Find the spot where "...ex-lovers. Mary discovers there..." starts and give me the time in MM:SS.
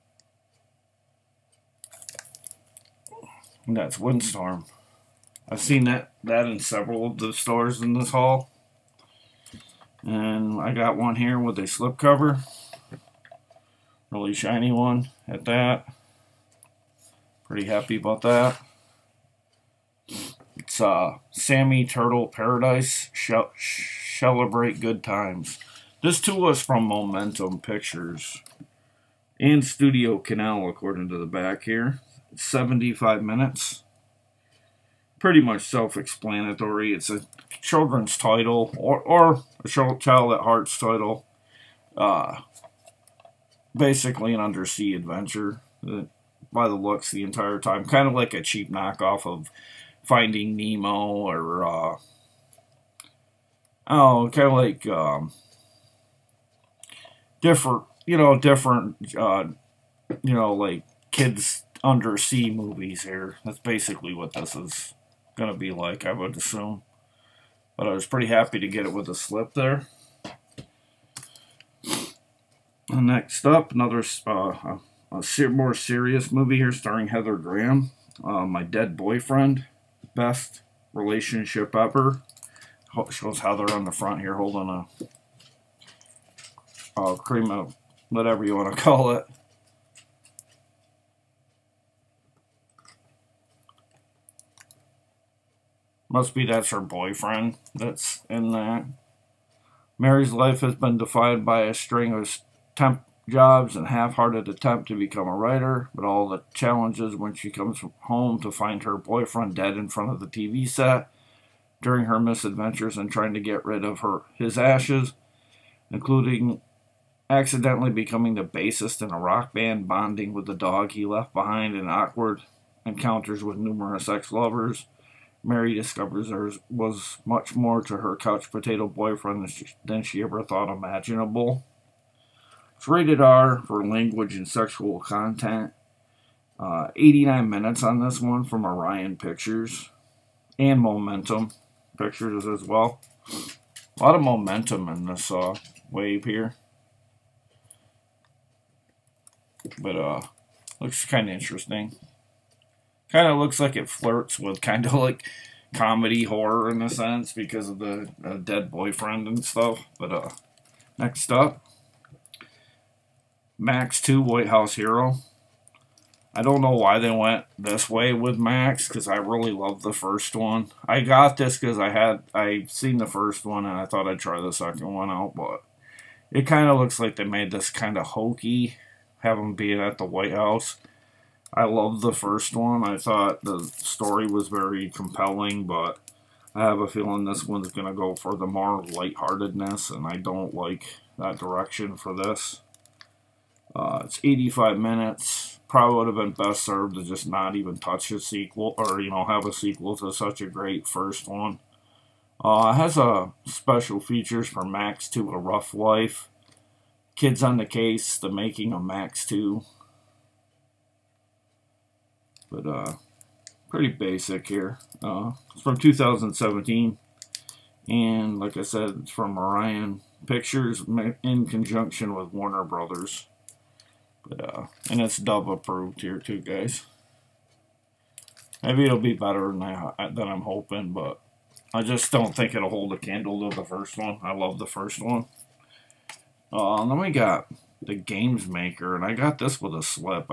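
02:04.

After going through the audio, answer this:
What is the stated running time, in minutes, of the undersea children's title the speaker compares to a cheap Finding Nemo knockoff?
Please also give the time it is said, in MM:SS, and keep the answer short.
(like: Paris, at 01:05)
75, at 00:32.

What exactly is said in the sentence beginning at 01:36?
Must be that's her boyfriend that's in that.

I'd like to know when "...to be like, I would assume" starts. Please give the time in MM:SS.
01:05.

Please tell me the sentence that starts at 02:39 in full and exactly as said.
But uh, next up, Max 2 White House Hero.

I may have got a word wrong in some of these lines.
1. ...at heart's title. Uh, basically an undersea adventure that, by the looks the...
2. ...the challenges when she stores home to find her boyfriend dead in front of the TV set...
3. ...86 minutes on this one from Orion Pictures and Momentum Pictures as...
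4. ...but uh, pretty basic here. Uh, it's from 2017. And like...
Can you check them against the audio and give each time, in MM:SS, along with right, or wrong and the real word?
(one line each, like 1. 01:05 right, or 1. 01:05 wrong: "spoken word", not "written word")
1. 00:40 right
2. 01:46 wrong: "comes", not "stores"
3. 02:16 wrong: "89", not "86"
4. 03:32 right.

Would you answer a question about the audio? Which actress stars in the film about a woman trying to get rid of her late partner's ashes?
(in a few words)
Heather Graham.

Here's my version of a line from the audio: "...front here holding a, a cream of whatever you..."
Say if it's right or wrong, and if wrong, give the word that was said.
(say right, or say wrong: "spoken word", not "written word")
right.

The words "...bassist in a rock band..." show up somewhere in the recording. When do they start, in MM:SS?
01:58.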